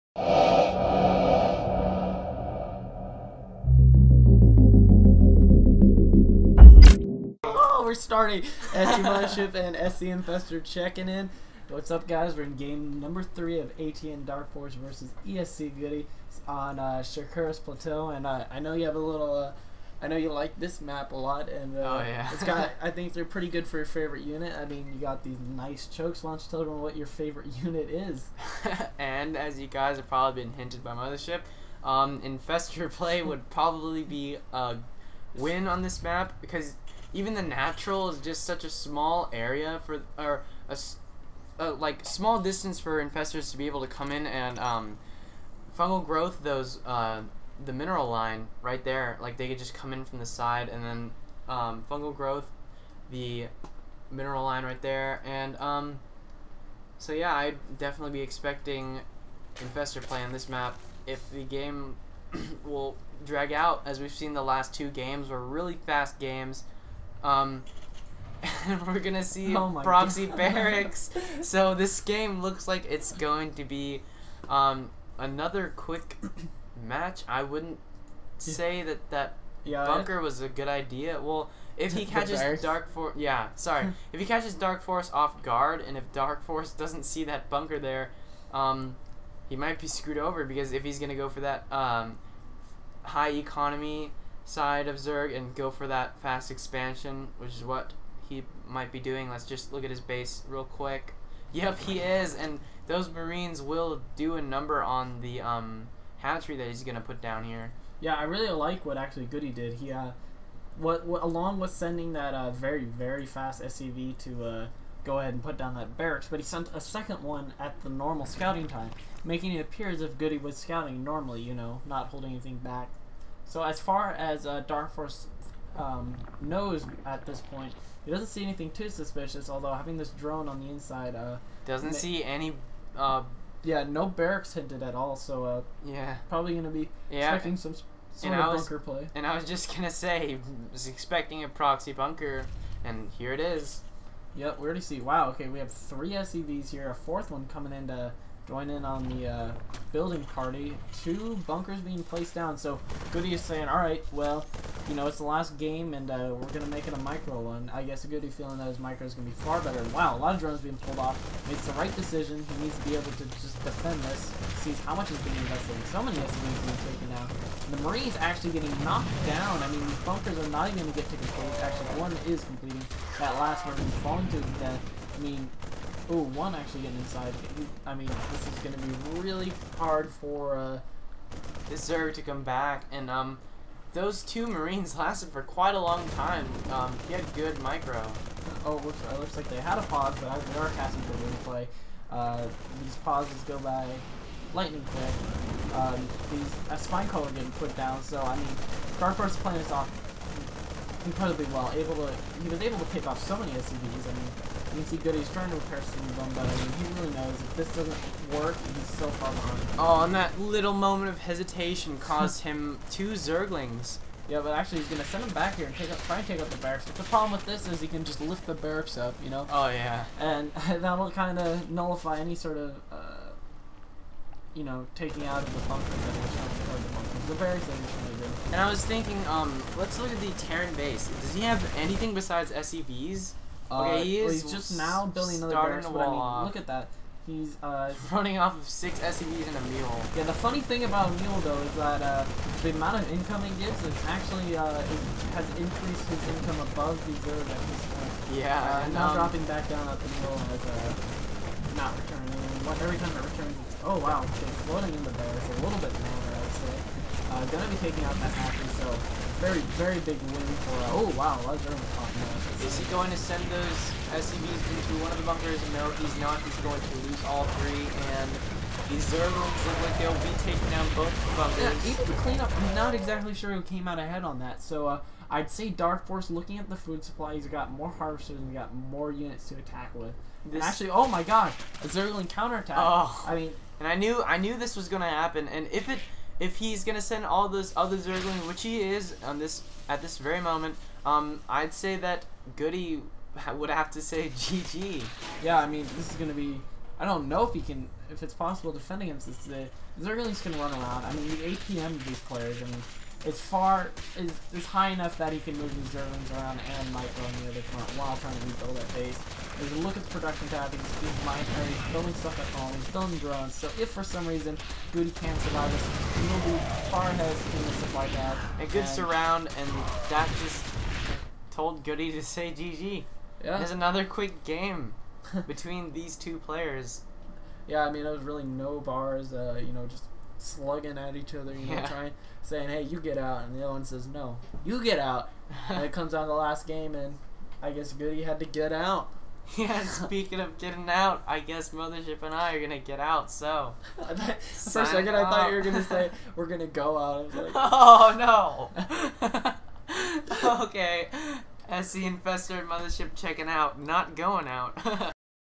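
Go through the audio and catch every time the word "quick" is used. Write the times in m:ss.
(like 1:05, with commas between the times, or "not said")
1:15, 1:40, 3:14, 5:24.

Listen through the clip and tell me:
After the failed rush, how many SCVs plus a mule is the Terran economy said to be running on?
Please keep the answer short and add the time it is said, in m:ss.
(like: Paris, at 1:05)
6, at 3:58.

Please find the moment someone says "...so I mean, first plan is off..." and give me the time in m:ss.
3:18.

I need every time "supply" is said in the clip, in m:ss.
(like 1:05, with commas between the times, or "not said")
4:37, 5:17.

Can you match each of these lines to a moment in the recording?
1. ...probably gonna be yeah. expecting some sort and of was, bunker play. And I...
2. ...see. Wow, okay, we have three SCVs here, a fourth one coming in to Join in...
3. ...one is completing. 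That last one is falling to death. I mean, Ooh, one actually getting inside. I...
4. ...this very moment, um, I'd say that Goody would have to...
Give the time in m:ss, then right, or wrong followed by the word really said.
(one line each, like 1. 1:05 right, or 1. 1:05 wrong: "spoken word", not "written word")
1. 2:16 right
2. 2:24 right
3. 2:52 right
4. 4:50 right.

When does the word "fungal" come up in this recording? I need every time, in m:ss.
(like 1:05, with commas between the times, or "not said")
0:45, 0:51.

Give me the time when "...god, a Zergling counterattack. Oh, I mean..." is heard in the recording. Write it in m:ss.
4:41.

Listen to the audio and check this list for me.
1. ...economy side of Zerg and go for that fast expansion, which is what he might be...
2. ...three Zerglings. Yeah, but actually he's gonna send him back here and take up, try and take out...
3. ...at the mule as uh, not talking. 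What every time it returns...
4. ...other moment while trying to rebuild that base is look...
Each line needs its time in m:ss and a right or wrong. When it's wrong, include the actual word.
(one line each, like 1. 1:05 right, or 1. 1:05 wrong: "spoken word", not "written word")
1. 1:33 right
2. 3:32 wrong: "two", not "three"
3. 4:09 wrong: "returning", not "talking"
4. 5:07 wrong: "front", not "moment".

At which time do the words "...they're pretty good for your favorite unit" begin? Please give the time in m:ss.
0:23.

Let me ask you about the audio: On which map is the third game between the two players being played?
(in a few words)
Shakuras Plateau.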